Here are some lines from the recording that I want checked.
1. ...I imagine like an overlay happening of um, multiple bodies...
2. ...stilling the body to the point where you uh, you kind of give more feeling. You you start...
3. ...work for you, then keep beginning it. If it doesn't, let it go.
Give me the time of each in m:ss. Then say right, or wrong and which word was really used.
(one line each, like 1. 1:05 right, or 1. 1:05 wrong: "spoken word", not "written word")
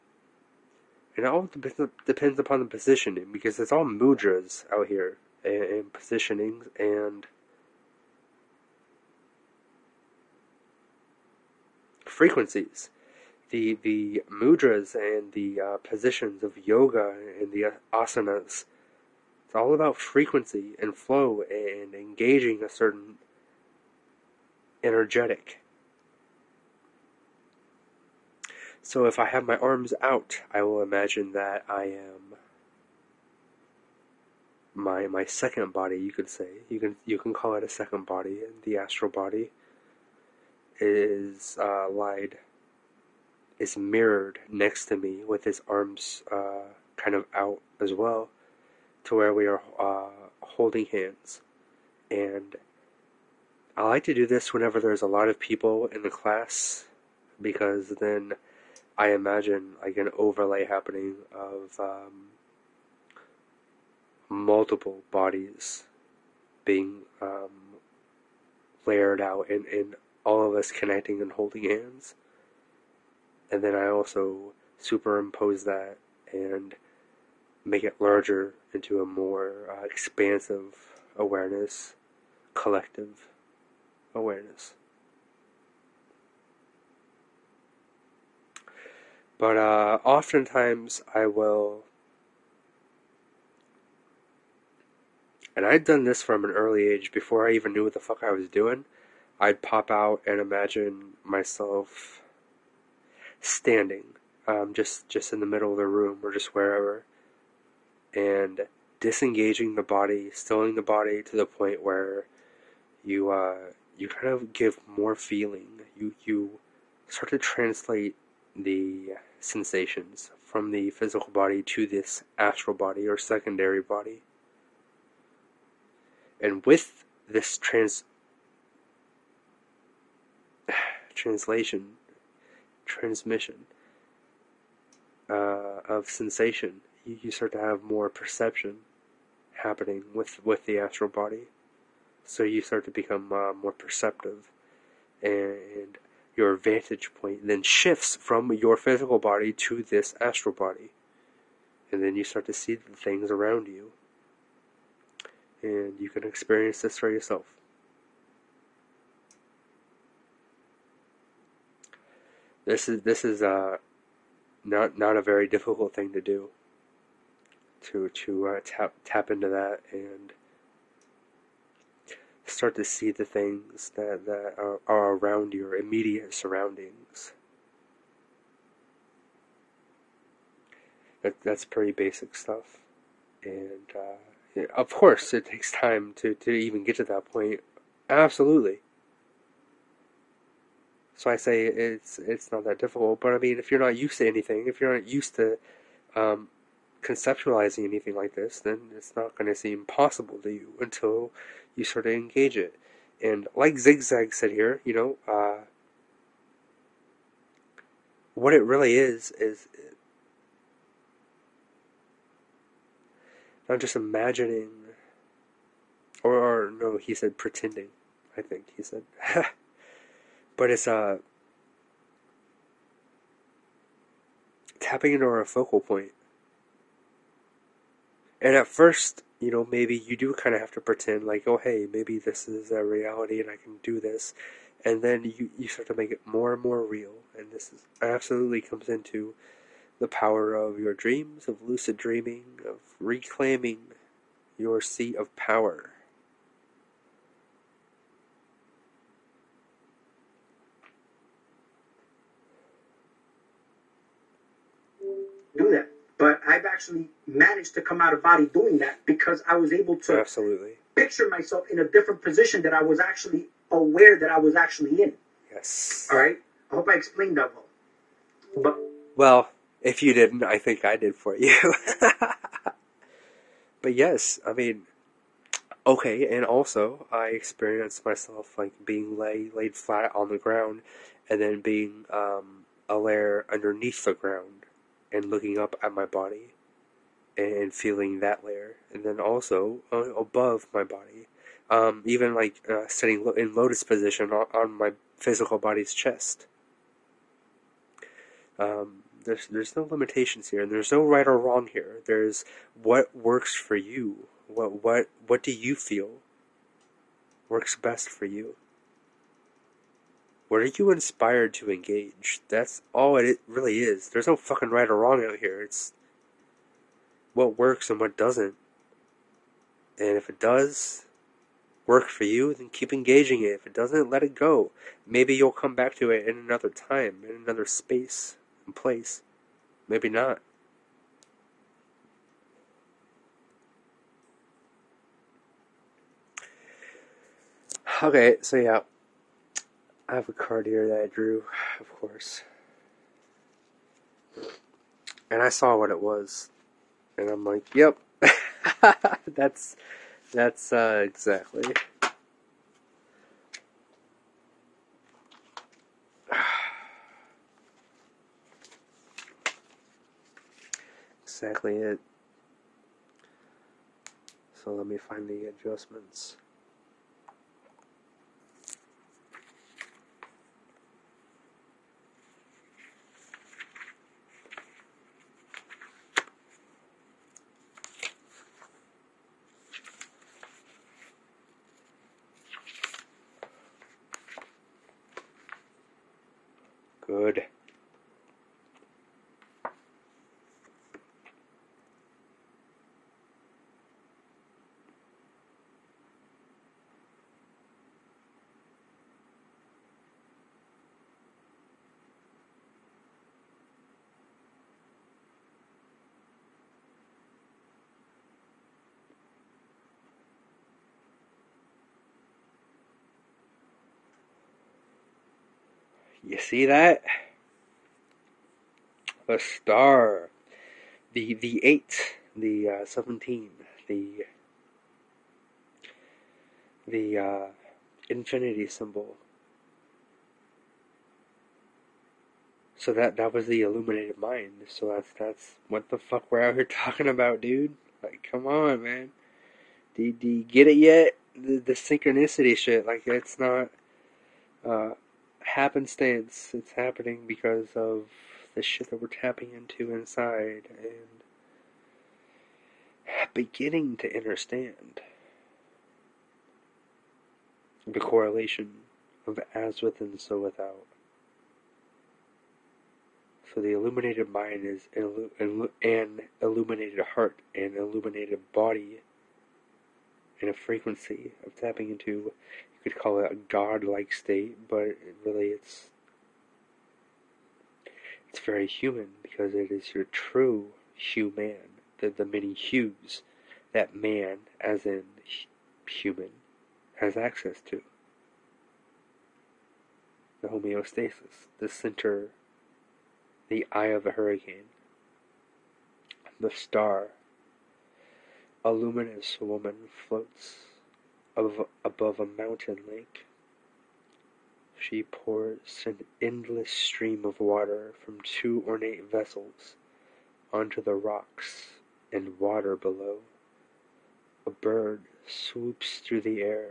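1. 0:58 right
2. 1:50 right
3. 5:21 wrong: "engaging", not "beginning".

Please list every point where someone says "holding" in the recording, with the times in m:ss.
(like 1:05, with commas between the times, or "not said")
0:50, 1:11.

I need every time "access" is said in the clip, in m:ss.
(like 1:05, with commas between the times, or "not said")
8:07.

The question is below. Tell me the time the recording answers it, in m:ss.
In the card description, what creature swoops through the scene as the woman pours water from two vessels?
8:34.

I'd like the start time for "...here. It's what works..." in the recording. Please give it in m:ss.
5:15.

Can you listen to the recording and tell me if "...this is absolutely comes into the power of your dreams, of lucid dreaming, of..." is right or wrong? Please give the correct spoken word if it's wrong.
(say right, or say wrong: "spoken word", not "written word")
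right.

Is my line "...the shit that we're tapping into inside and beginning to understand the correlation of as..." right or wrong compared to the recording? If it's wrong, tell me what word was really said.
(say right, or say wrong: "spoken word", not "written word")
right.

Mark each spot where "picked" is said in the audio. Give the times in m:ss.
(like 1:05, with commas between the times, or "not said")
not said.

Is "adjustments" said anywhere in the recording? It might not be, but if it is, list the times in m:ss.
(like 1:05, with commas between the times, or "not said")
6:05.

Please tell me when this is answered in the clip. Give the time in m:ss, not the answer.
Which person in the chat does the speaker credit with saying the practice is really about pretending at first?
3:23.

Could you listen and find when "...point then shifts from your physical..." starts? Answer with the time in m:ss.
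2:27.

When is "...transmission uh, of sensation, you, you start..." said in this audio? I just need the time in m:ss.
2:12.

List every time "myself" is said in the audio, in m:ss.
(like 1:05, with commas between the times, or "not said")
1:41, 4:21, 4:38.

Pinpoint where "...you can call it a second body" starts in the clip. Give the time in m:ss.
0:37.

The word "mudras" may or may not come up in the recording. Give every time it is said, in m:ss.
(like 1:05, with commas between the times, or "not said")
0:03, 0:14.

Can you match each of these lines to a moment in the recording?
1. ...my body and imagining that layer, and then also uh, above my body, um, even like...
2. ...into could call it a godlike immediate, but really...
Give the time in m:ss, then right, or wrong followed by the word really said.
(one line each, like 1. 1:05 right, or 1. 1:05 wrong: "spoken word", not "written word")
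1. 4:45 wrong: "feeling", not "imagining"
2. 7:51 wrong: "state", not "immediate".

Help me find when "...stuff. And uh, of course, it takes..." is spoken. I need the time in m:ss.
3:02.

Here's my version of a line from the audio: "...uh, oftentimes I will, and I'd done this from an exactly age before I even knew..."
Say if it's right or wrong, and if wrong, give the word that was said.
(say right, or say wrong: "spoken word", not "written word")
wrong: "early", not "exactly".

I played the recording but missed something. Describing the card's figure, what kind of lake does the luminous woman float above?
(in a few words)
a mountain lake.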